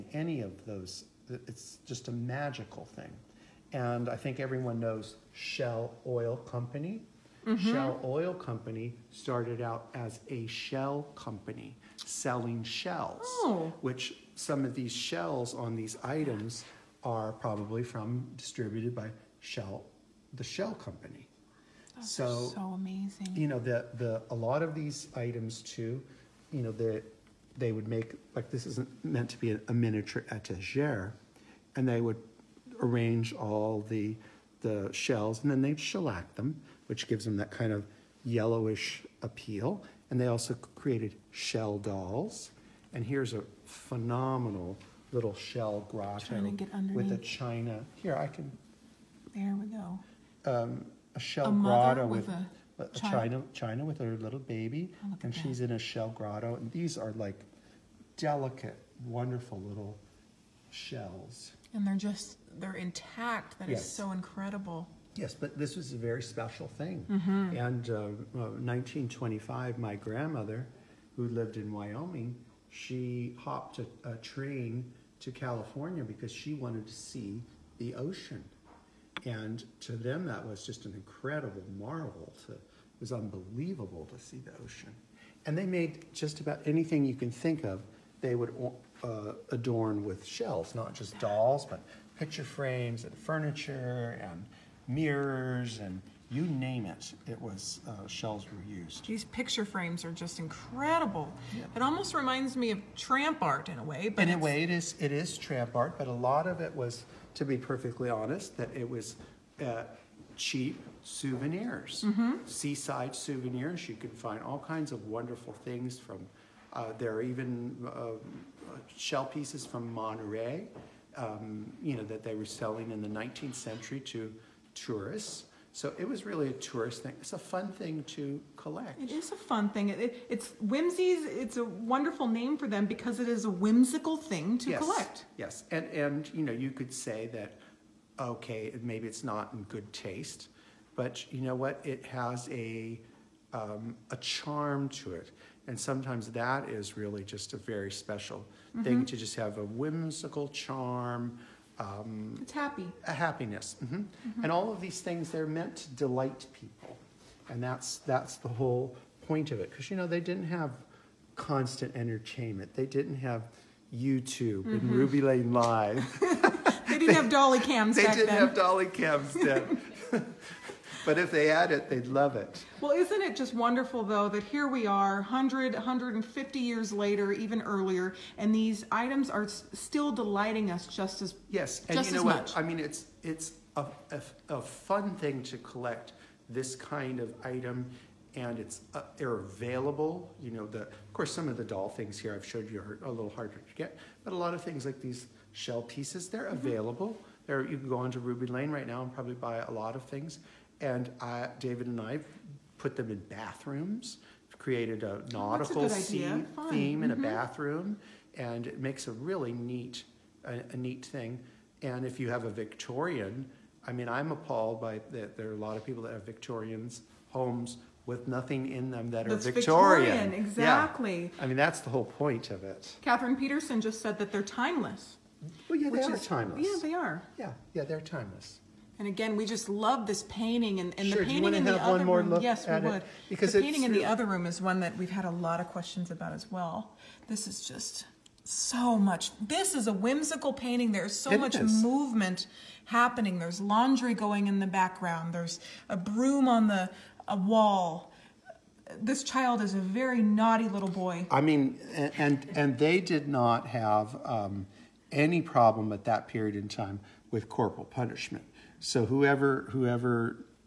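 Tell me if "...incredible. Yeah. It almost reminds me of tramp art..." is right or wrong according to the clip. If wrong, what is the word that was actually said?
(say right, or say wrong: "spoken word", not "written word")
right.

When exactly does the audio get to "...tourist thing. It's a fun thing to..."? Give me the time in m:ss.
2:06.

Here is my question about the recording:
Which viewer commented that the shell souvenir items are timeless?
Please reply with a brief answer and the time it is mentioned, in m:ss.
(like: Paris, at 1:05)
Catherine Peterson, at 3:43.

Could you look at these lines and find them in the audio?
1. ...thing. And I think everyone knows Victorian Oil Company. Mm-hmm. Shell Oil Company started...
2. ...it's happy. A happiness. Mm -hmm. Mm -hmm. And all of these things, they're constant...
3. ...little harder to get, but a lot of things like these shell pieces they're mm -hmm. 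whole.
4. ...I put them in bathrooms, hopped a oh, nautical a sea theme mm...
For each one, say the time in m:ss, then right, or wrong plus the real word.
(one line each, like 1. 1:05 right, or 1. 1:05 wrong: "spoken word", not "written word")
1. 0:02 wrong: "Shell", not "Victorian"
2. 2:32 wrong: "meant", not "constant"
3. 3:13 wrong: "available", not "whole"
4. 3:22 wrong: "created", not "hopped".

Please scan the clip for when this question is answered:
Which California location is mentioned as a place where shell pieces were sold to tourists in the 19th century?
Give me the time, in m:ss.
1:59.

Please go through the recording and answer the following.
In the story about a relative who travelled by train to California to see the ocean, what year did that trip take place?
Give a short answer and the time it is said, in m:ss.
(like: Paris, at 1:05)
1925, at 1:08.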